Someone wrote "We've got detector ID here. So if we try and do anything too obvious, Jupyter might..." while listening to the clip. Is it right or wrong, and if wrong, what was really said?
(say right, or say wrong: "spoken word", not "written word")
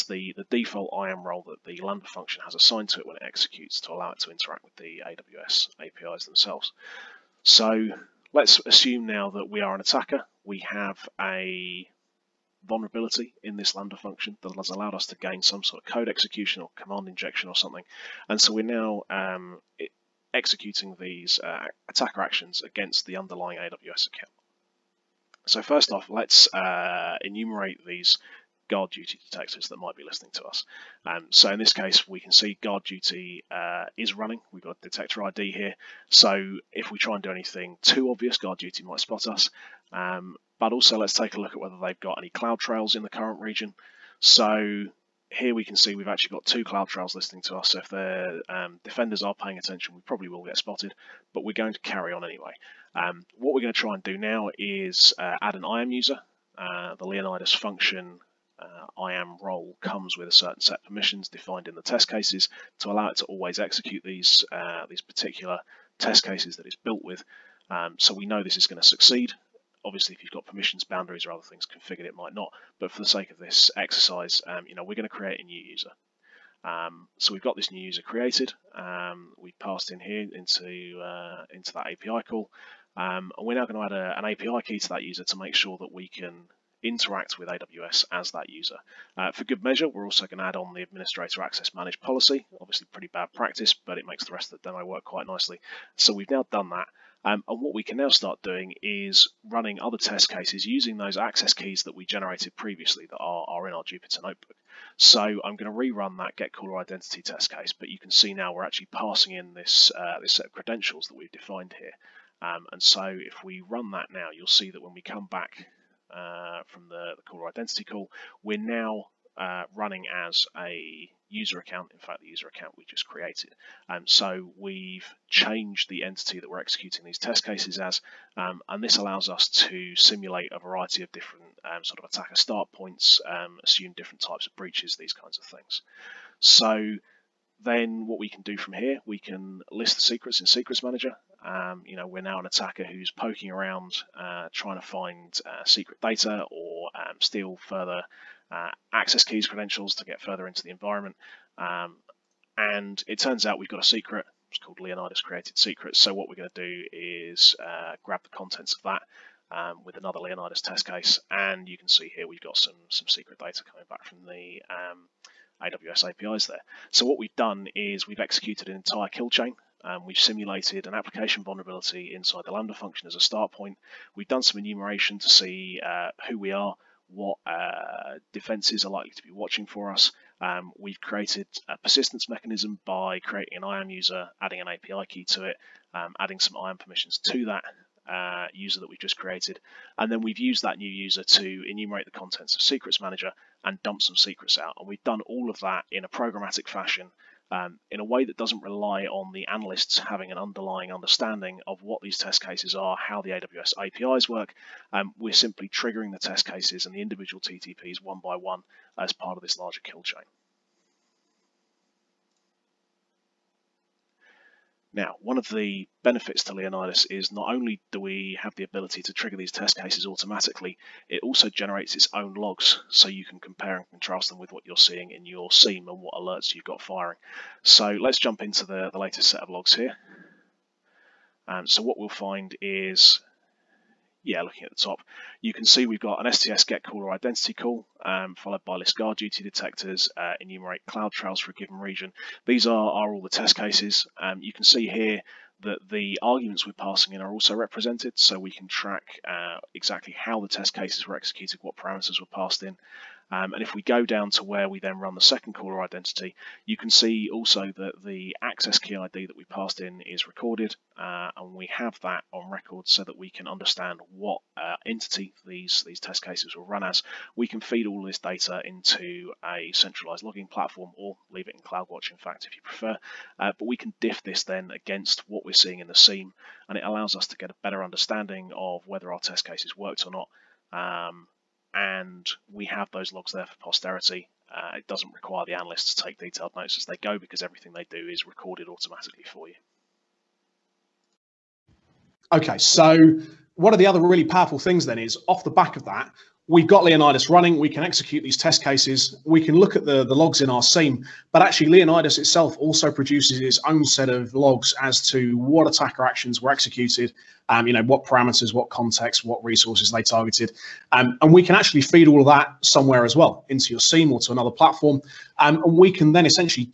wrong: "GuardDuty", not "Jupyter".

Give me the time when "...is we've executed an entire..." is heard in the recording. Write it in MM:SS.
02:47.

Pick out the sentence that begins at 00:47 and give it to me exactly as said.
So if the um, defenders are paying attention, we probably will get spotted, but we're going to carry on anyway.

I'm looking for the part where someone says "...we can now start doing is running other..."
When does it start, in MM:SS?
01:37.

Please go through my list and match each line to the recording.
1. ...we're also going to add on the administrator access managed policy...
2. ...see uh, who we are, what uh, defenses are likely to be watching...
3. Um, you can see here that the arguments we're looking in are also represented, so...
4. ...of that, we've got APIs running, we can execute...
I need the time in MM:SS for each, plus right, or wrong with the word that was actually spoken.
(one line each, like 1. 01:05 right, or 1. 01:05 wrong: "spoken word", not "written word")
1. 01:29 right
2. 02:55 right
3. 04:04 wrong: "passing", not "looking"
4. 04:55 wrong: "Leonidas", not "APIs".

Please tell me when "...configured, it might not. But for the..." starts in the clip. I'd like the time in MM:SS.
01:11.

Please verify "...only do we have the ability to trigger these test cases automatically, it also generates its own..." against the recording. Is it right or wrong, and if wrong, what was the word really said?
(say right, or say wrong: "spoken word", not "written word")
right.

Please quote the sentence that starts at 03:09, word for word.
And then we've used that new user to enumerate the contents of Secrets Manager and dump some secrets out.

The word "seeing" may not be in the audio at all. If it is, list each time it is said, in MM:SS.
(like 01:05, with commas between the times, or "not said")
03:44, 04:35.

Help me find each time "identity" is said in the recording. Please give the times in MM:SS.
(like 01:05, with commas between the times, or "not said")
01:46, 01:57, 03:57, 04:15.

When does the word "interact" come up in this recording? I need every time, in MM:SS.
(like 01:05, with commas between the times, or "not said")
00:04, 01:26.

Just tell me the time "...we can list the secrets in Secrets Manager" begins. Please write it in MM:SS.
02:19.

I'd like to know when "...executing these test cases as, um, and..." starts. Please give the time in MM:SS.
02:06.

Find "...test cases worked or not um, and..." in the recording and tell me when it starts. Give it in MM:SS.
04:39.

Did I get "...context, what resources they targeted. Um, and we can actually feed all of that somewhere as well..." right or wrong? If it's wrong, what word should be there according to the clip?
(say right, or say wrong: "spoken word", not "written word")
right.